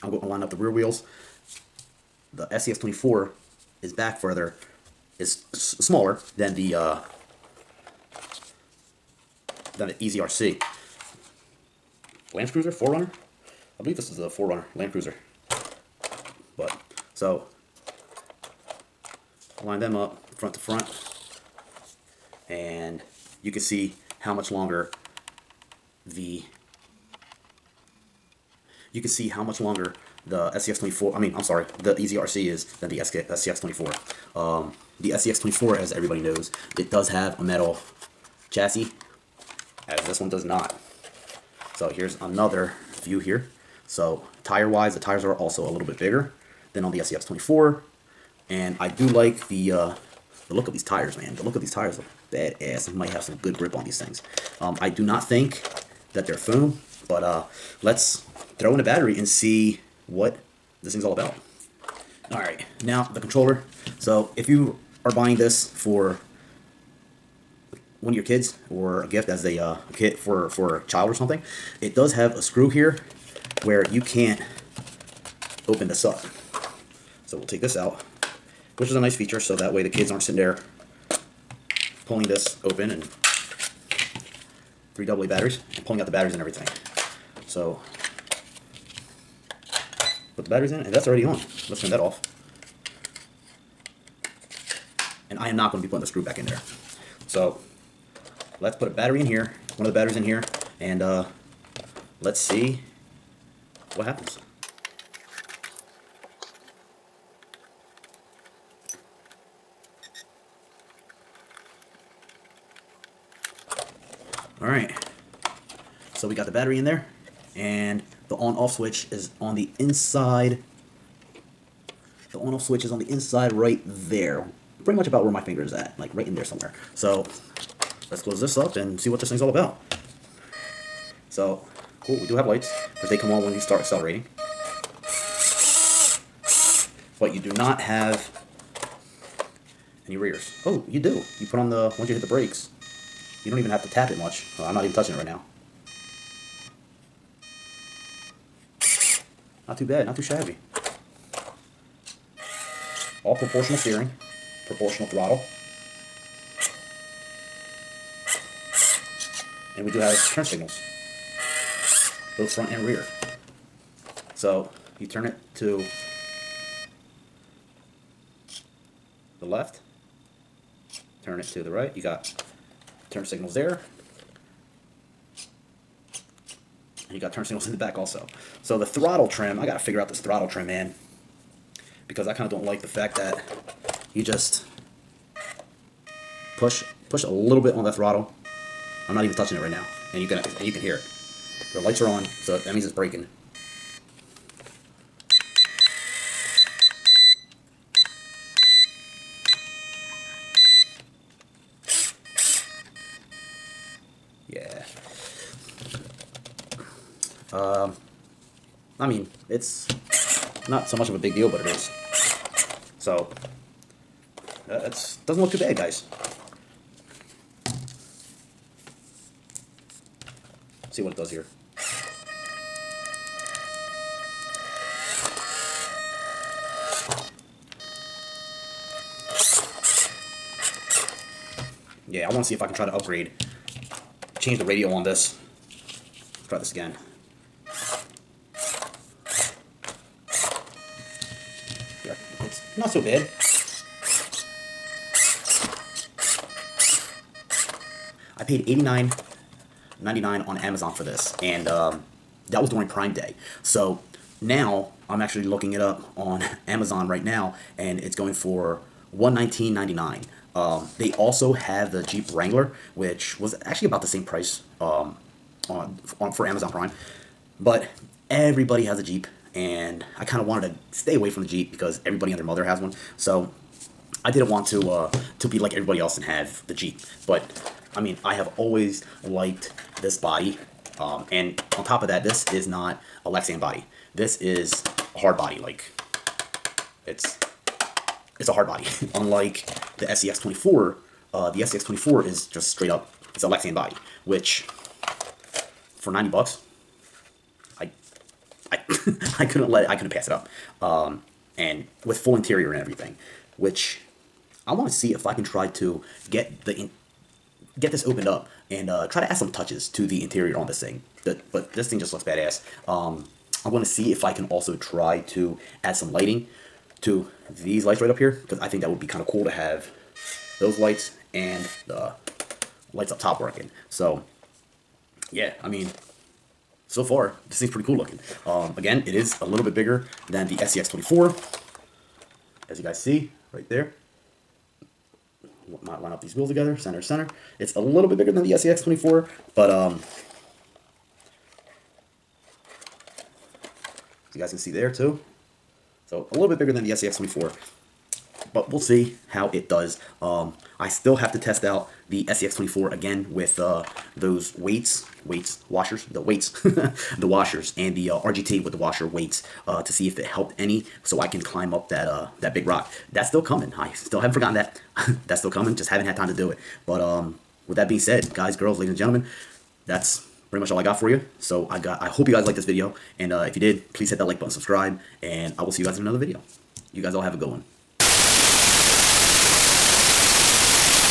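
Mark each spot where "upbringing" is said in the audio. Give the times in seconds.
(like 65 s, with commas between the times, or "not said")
not said.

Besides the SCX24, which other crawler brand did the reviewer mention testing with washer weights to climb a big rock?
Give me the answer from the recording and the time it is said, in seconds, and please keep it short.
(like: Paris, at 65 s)
RGT, at 358 s.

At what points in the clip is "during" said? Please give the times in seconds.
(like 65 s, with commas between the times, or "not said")
252 s.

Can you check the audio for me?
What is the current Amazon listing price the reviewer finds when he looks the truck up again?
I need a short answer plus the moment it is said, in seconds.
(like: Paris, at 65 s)
$119.99, at 259 s.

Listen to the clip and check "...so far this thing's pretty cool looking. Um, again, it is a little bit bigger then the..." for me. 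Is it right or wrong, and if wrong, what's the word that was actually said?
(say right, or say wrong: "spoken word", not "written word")
right.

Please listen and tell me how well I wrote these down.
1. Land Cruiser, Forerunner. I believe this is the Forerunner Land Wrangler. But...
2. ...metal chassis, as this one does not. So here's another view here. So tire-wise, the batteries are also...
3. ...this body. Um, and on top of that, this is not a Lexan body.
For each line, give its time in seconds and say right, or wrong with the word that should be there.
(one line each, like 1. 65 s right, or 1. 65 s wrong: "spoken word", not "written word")
1. 12 s wrong: "Cruiser", not "Wrangler"
2. 37 s wrong: "tires", not "batteries"
3. 280 s right.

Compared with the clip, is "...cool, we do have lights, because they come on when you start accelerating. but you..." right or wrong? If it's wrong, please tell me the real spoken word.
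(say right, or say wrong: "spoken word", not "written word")
right.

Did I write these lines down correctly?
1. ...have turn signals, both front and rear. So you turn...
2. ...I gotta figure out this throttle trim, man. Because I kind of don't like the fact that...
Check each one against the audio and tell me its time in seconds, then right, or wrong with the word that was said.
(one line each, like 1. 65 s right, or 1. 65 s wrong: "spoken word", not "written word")
1. 159 s right
2. 179 s right.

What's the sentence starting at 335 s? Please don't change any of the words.
Might line up these wheels together, center, center.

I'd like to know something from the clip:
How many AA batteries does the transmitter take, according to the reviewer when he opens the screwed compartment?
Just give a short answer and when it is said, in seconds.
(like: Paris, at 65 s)
3, at 84 s.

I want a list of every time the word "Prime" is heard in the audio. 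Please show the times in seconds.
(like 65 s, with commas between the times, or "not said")
252 s, 266 s.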